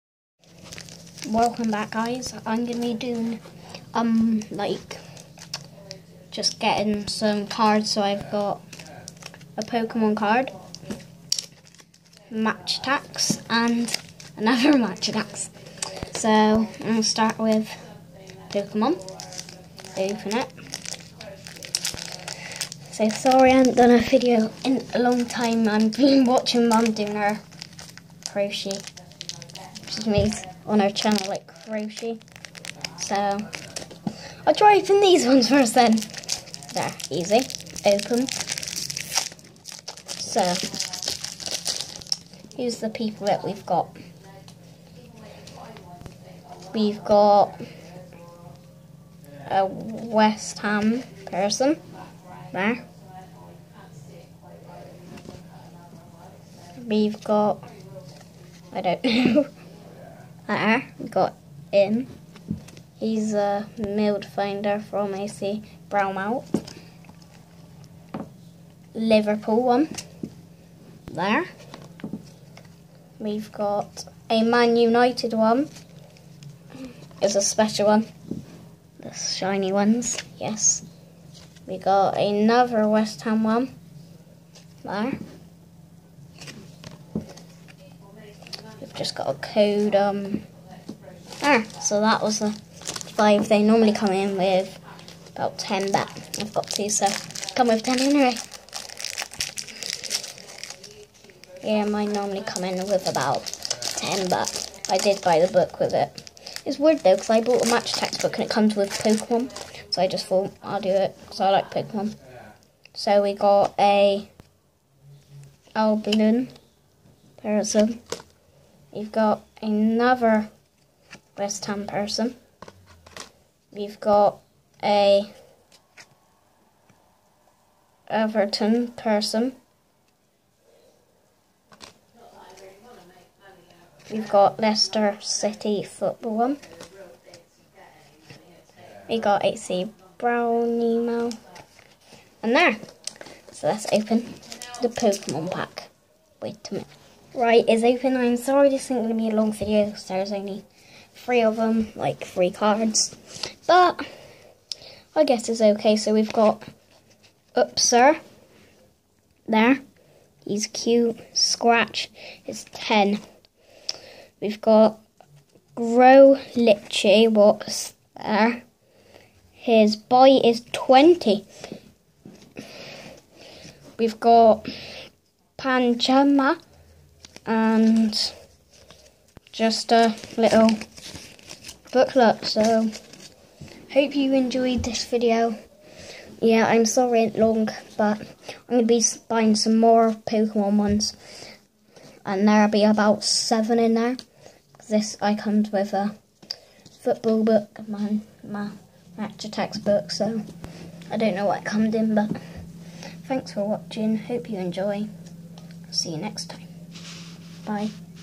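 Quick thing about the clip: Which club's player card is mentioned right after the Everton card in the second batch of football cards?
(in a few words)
Leicester City.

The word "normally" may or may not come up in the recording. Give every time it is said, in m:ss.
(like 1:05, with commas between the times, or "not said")
1:33, 1:42.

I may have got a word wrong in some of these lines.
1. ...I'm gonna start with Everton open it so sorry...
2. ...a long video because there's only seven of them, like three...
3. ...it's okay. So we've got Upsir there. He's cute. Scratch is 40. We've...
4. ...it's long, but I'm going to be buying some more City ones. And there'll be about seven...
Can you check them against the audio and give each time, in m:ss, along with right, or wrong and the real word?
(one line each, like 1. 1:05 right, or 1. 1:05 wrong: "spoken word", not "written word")
1. 0:16 wrong: "Pokemon", not "Everton"
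2. 2:29 wrong: "three", not "seven"
3. 2:35 wrong: "10", not "40"
4. 3:07 wrong: "Pokemon", not "City".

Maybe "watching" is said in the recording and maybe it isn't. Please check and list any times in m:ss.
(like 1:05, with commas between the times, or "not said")
0:26, 3:23.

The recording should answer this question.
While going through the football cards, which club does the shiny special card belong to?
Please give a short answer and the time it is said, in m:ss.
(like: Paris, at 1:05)
Man United, at 1:14.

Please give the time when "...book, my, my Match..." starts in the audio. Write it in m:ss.
3:17.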